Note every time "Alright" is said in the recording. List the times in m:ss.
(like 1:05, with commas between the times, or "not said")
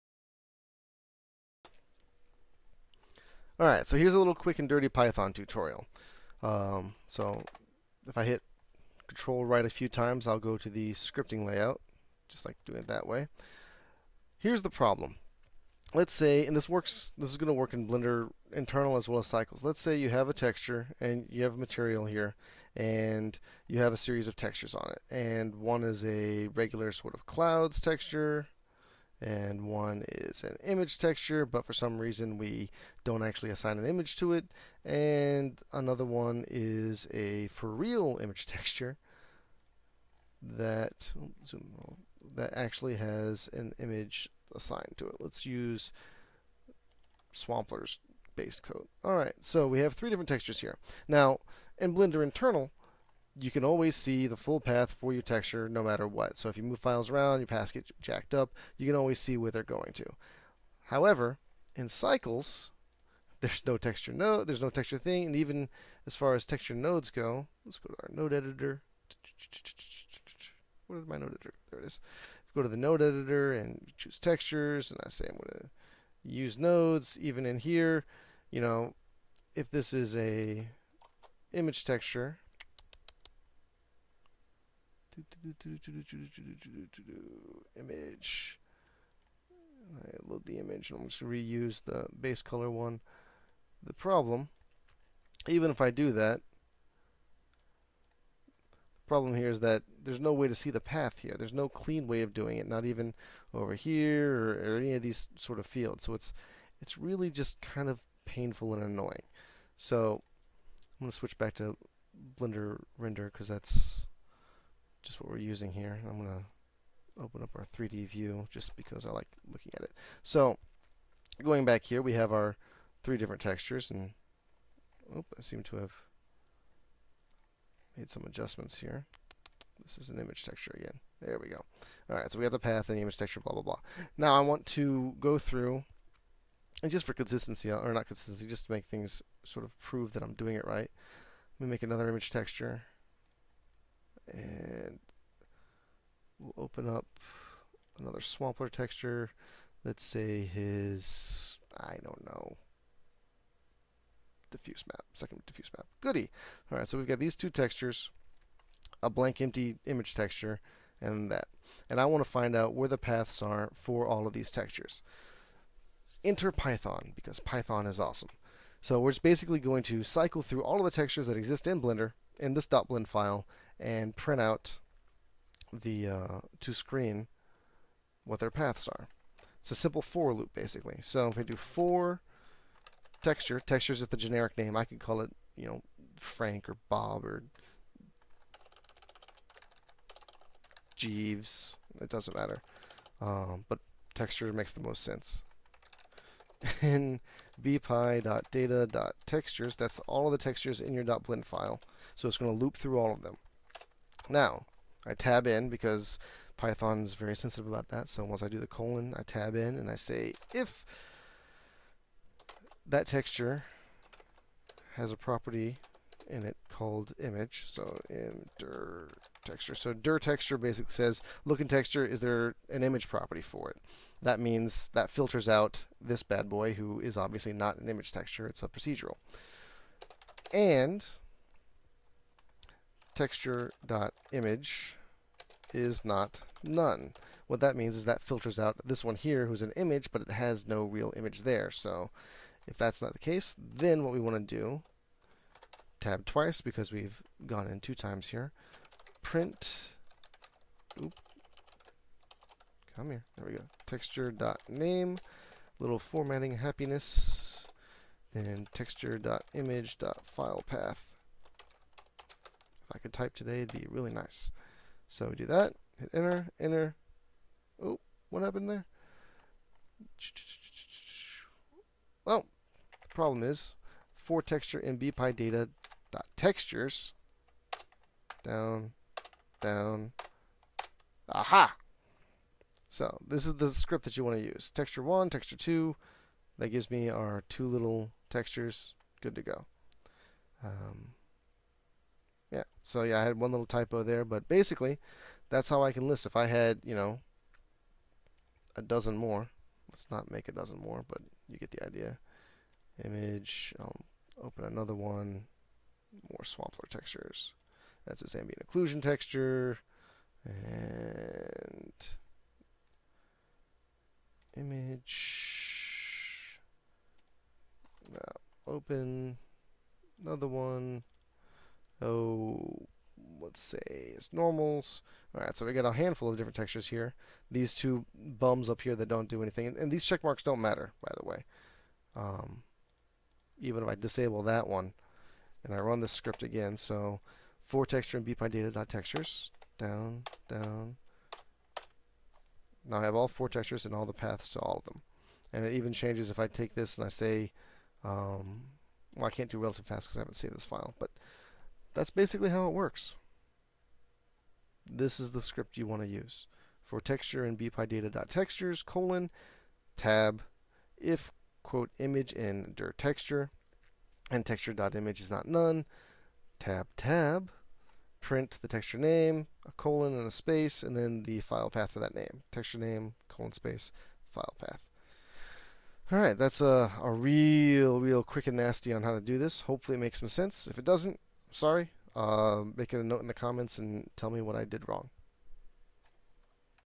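0:03, 0:49, 2:36.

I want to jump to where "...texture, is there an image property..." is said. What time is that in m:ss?
3:41.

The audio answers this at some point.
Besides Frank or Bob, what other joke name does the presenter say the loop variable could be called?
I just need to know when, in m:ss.
3:10.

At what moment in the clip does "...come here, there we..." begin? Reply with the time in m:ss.
4:12.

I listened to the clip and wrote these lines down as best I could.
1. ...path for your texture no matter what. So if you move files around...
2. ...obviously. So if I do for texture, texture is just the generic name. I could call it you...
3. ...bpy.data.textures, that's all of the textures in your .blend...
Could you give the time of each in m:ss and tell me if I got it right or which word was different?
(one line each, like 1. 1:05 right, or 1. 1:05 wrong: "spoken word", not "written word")
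1. 0:54 right
2. 3:00 wrong: "basically", not "obviously"
3. 3:17 right.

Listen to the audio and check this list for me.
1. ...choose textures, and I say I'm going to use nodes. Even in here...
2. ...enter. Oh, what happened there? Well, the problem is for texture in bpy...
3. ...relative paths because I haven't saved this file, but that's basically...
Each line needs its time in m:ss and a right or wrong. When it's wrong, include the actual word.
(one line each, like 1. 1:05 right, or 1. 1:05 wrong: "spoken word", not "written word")
1. 1:13 right
2. 4:26 right
3. 5:49 right.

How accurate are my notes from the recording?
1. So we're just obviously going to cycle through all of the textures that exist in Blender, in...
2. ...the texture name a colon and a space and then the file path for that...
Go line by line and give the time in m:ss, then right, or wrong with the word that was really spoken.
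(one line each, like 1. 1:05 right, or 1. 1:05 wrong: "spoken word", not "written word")
1. 2:48 wrong: "basically", not "obviously"
2. 6:08 right.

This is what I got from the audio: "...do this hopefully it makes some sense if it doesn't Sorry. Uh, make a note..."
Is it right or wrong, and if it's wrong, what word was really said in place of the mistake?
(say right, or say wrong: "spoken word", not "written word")
right.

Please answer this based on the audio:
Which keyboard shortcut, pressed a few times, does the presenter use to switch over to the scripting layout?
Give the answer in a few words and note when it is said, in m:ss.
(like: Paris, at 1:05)
Control right, at 0:09.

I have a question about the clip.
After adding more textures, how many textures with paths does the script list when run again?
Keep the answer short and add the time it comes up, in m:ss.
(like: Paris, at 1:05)
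4, at 5:43.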